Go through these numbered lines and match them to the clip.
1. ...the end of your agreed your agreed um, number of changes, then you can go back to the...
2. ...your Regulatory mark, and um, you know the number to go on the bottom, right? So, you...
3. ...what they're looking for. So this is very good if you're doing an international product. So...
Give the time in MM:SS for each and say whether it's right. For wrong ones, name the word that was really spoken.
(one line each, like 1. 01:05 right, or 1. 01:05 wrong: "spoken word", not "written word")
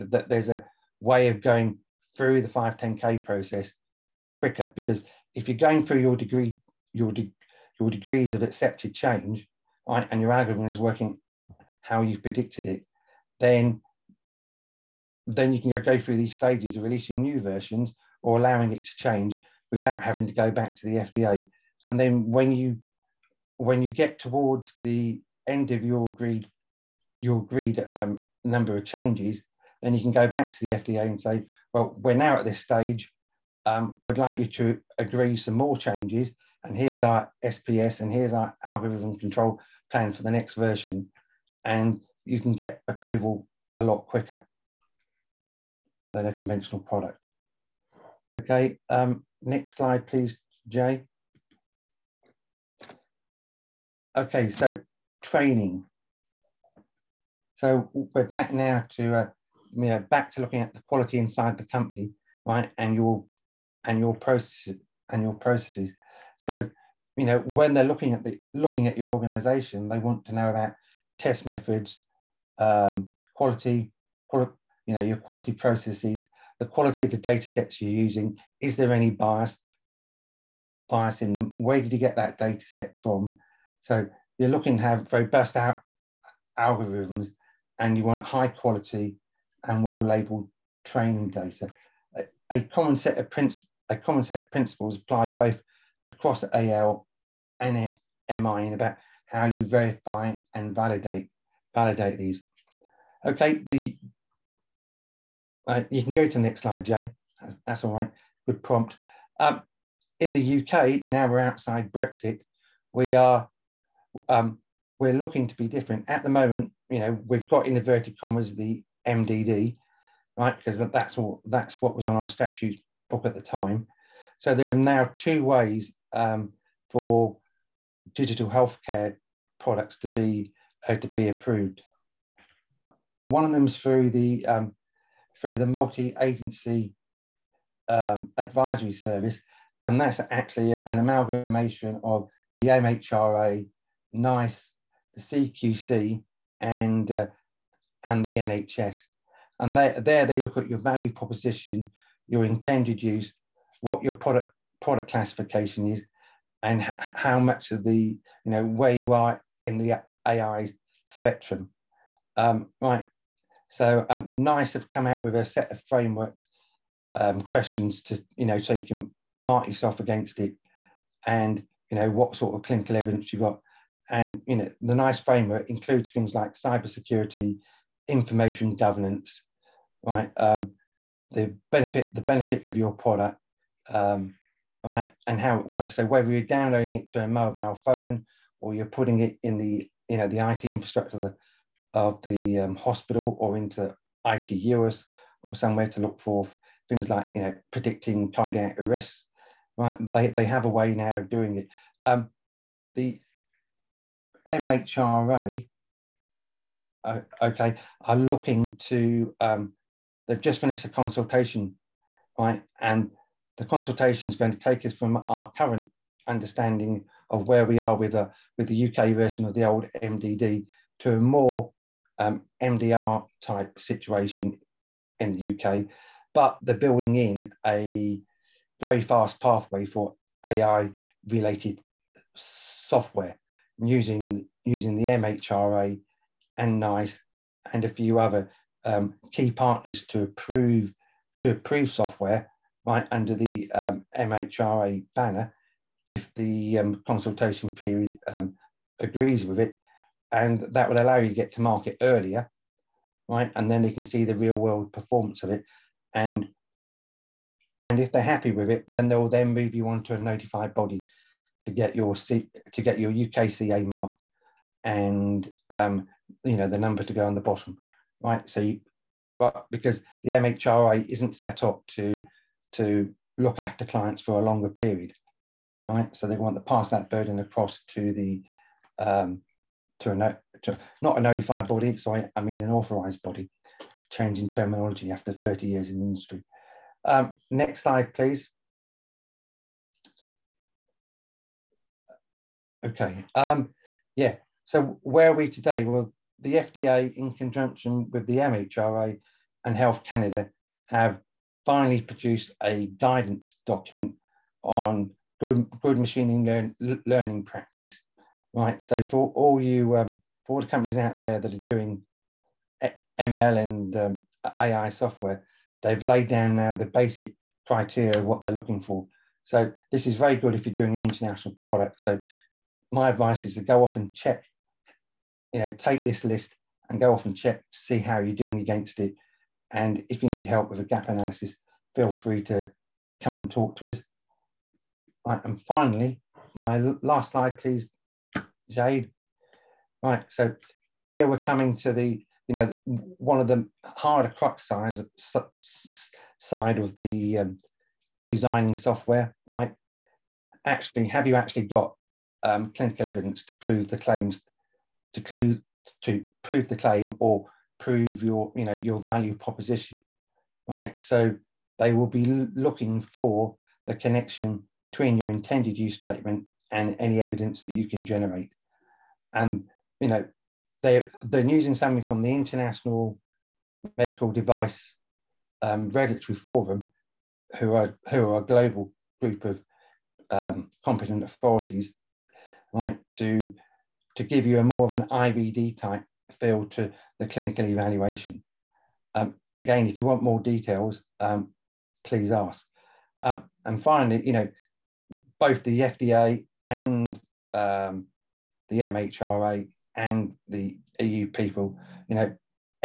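1. 00:24 right
2. 04:22 wrong: "UKCA", not "Regulatory"
3. 05:18 right.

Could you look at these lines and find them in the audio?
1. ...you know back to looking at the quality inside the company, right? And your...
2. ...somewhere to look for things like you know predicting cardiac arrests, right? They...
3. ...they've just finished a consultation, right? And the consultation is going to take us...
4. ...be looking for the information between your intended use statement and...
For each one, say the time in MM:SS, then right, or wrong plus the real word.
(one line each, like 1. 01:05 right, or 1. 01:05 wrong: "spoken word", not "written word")
1. 00:59 right
2. 03:15 right
3. 03:30 right
4. 06:02 wrong: "connection", not "information".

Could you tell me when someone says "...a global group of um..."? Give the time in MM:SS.
06:18.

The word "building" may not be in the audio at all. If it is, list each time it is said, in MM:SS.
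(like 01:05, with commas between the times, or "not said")
03:46.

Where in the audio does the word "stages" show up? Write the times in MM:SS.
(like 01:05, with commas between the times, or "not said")
00:16, 00:32.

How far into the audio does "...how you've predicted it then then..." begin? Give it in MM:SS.
00:11.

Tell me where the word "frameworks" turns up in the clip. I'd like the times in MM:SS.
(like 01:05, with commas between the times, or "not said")
02:45, 02:55.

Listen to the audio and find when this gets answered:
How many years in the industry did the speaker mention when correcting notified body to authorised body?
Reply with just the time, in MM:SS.
04:45.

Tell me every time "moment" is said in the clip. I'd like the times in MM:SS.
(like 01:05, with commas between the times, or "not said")
01:56.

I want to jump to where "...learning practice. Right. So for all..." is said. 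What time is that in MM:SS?
05:07.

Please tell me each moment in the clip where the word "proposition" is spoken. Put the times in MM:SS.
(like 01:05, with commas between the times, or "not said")
02:31, 05:59.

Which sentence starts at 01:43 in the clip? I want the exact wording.
Okay, the uh, you can go to the next slide, Jay.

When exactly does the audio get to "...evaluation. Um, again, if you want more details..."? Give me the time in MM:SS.
06:27.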